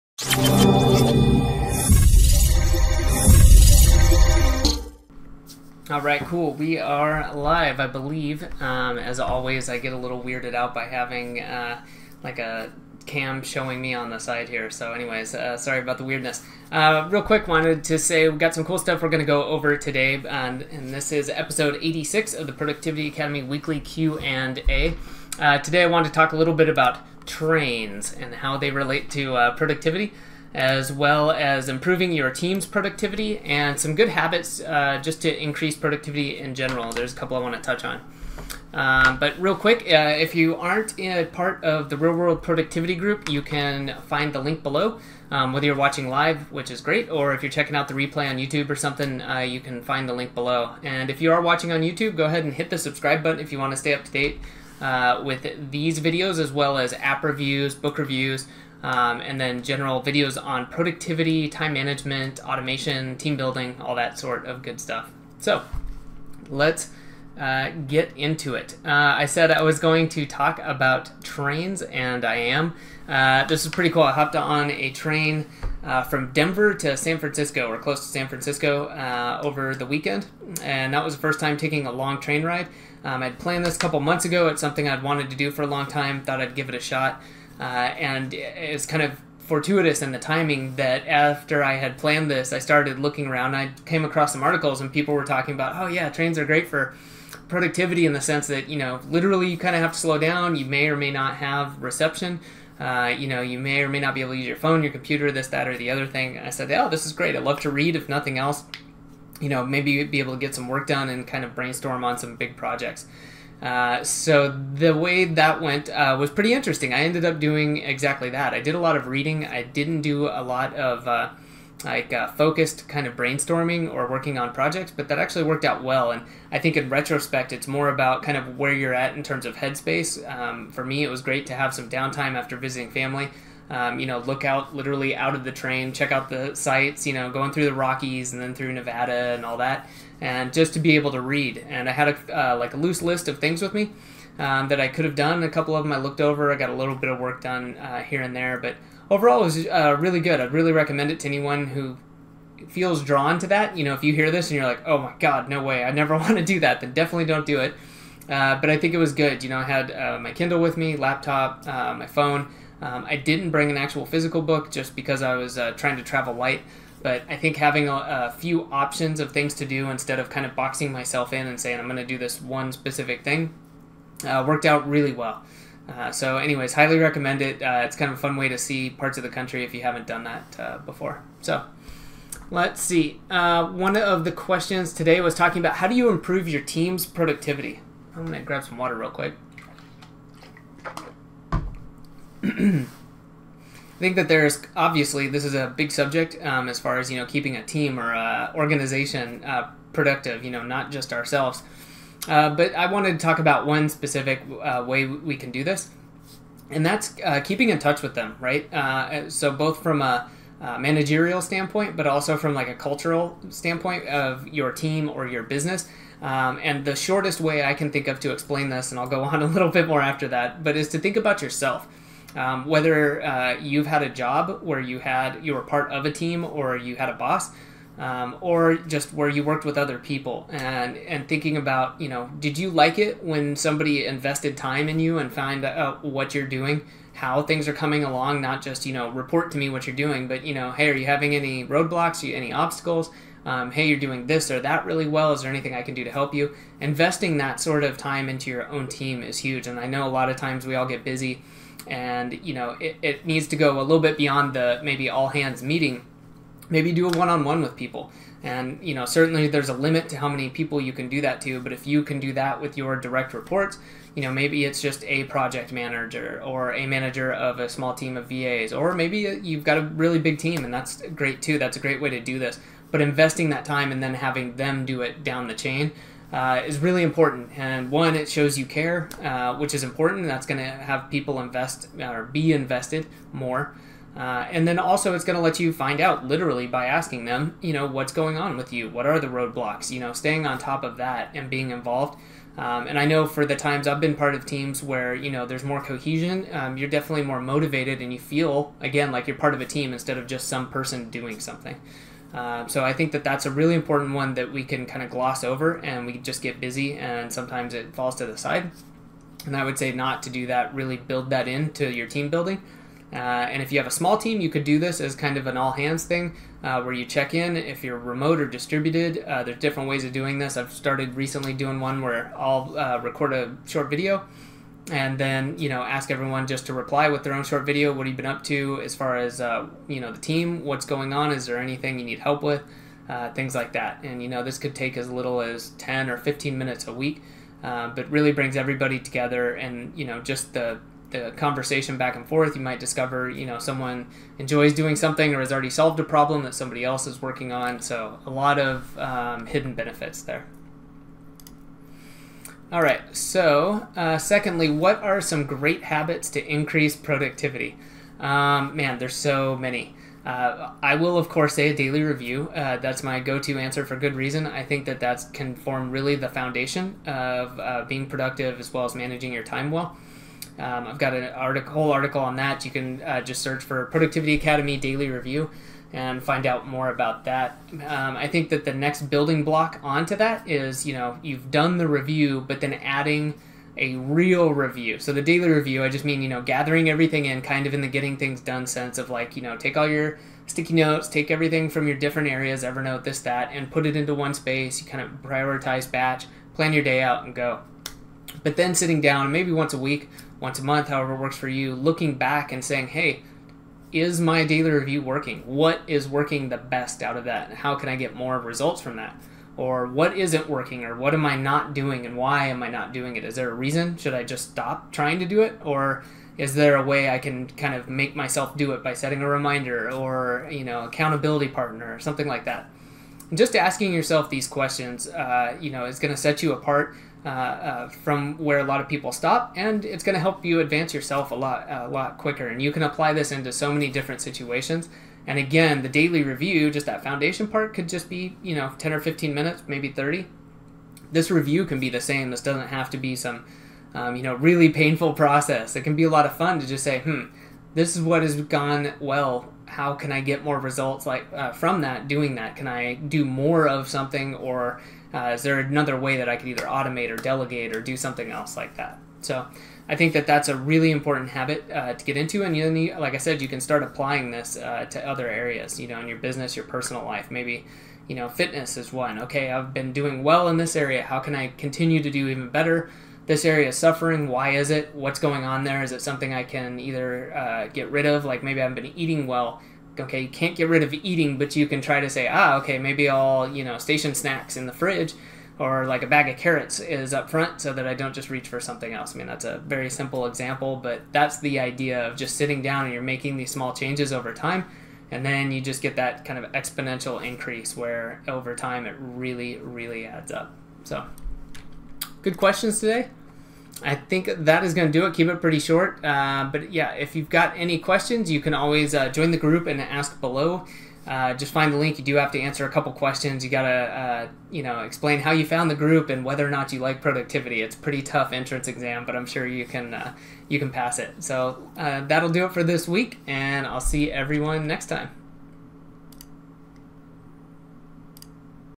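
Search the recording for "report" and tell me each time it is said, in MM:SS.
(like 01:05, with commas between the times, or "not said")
03:59, 04:23.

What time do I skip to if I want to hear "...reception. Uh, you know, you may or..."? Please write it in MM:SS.
01:41.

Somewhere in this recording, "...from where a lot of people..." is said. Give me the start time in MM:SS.
07:07.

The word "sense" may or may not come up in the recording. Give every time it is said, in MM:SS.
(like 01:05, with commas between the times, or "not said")
01:38, 06:28.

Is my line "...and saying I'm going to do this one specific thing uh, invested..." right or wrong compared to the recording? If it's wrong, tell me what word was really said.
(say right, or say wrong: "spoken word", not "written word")
wrong: "worked", not "invested".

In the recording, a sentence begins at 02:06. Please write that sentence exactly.
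And I think in retrospect, it's more about kind of where you're at in terms of headspace.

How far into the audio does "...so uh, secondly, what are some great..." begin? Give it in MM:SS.
05:53.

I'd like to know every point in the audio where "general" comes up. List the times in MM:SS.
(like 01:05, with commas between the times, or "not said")
00:36, 00:59.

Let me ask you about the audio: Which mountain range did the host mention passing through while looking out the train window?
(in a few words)
the Rockies.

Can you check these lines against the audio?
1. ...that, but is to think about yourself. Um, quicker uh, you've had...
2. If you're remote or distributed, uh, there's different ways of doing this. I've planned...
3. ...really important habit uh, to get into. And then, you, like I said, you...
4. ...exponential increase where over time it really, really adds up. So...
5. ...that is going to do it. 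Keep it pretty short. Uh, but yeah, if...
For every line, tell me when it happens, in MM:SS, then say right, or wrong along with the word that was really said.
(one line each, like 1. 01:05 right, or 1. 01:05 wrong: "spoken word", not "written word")
1. 03:40 wrong: "whether", not "quicker"
2. 05:17 wrong: "started", not "planned"
3. 07:40 right
4. 08:16 right
5. 08:24 right.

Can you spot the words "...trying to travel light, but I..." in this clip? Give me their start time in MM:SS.
02:45.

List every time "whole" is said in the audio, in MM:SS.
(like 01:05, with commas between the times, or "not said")
06:11.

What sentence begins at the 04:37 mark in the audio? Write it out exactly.
And one, it shows you care, uh, which is important.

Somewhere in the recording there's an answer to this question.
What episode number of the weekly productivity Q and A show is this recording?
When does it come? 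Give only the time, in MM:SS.
00:21.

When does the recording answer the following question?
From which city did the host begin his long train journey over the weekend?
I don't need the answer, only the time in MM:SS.
01:16.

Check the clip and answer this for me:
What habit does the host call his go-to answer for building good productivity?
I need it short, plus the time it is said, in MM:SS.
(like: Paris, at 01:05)
a daily review, at 06:01.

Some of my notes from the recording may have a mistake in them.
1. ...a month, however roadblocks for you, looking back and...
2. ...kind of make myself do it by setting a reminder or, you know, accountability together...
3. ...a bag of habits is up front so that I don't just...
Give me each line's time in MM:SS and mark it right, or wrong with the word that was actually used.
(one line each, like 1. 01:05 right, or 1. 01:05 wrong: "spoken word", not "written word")
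1. 06:40 wrong: "works", not "roadblocks"
2. 06:57 wrong: "partner", not "together"
3. 08:06 wrong: "carrots", not "habits".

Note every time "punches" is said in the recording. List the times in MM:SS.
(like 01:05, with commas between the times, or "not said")
not said.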